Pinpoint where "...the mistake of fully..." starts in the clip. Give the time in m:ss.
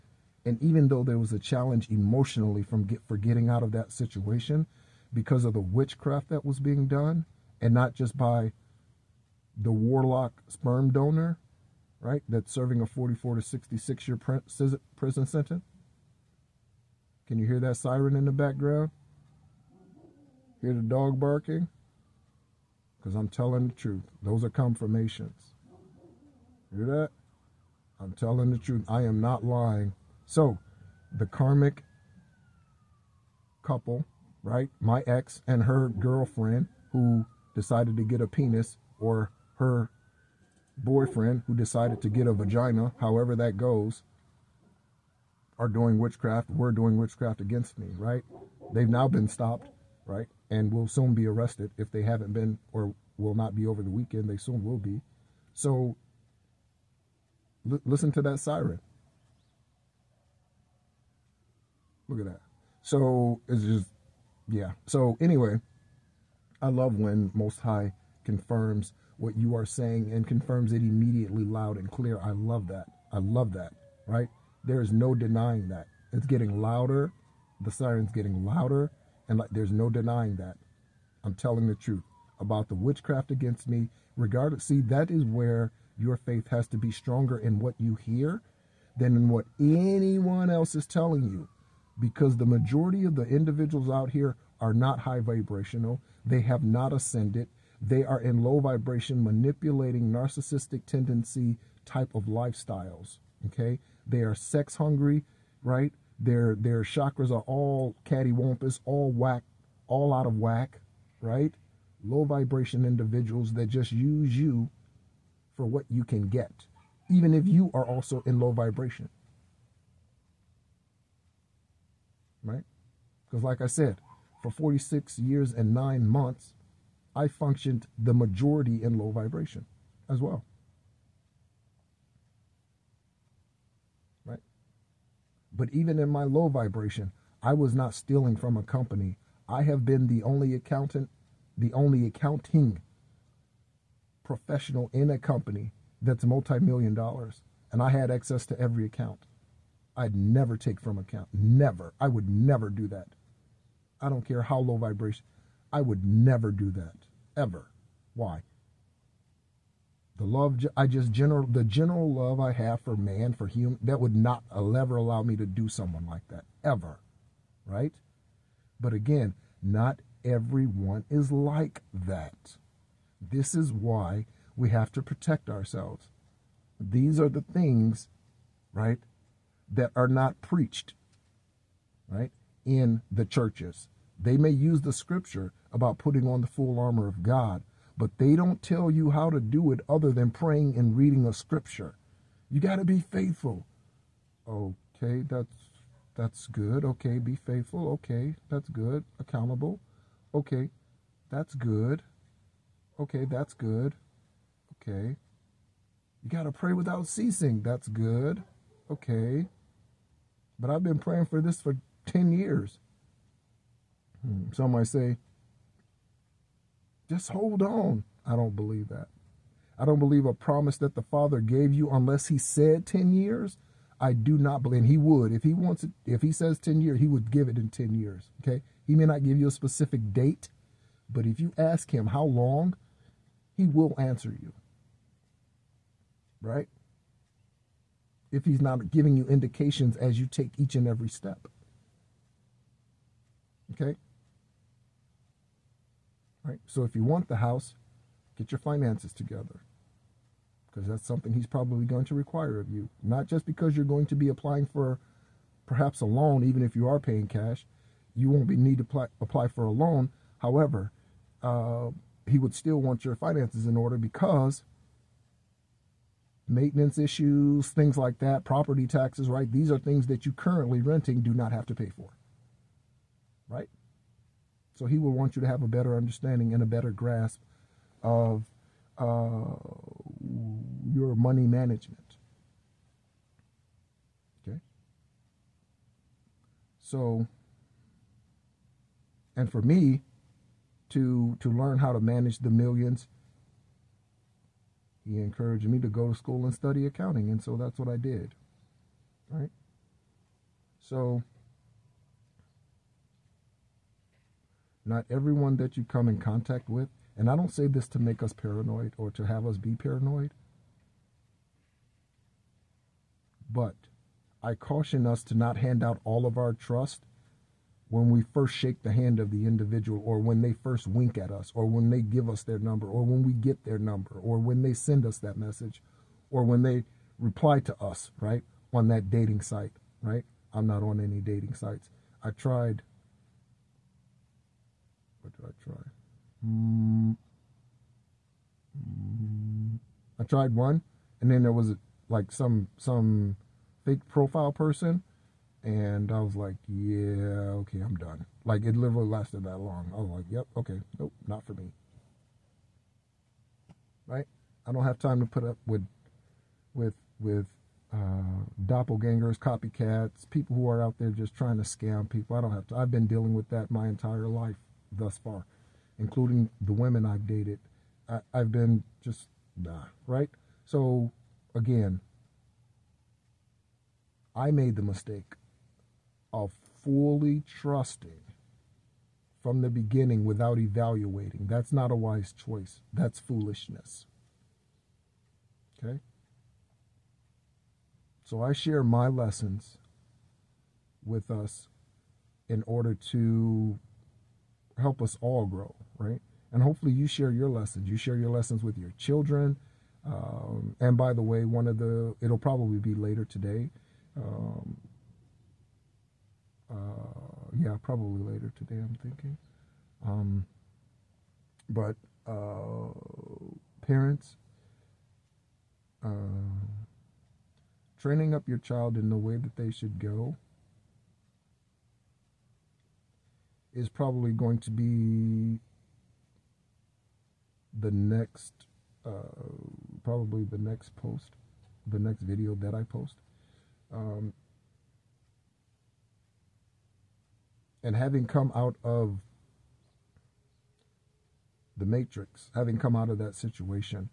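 6:14.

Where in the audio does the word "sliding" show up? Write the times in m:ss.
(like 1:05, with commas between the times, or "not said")
not said.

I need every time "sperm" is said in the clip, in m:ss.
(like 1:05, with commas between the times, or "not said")
0:10.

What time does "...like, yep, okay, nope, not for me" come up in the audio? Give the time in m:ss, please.
5:50.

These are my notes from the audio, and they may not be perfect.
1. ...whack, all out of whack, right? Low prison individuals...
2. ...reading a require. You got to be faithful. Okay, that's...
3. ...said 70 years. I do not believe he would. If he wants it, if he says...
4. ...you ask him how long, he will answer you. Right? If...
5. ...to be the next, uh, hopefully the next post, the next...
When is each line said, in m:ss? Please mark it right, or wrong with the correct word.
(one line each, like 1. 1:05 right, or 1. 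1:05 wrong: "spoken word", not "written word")
1. 1:49 wrong: "vibration", not "prison"
2. 3:10 wrong: "scripture", not "require"
3. 3:42 wrong: "10", not "70"
4. 3:51 right
5. 7:04 wrong: "probably", not "hopefully".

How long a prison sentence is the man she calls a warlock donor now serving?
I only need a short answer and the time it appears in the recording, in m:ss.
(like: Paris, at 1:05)
44 to 66 years, at 0:12.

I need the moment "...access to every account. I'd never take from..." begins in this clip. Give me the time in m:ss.
2:28.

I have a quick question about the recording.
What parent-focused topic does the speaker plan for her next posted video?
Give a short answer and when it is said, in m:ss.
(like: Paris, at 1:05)
training up your child, at 6:57.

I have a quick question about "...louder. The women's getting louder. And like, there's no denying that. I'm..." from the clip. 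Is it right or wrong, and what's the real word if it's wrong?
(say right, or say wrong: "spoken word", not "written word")
wrong: "siren", not "women".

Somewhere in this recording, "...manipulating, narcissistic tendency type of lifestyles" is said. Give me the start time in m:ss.
1:39.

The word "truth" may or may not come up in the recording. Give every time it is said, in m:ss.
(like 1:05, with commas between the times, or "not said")
0:23, 0:28, 1:21.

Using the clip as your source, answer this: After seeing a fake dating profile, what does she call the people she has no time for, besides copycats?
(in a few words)
doppelgangers.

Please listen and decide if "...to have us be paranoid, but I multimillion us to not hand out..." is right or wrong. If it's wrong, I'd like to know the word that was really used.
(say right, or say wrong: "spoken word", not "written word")
wrong: "caution", not "multimillion".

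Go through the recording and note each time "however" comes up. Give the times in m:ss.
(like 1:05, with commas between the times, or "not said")
0:43, 4:20.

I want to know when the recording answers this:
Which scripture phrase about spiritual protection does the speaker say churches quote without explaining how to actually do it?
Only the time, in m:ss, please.
3:06.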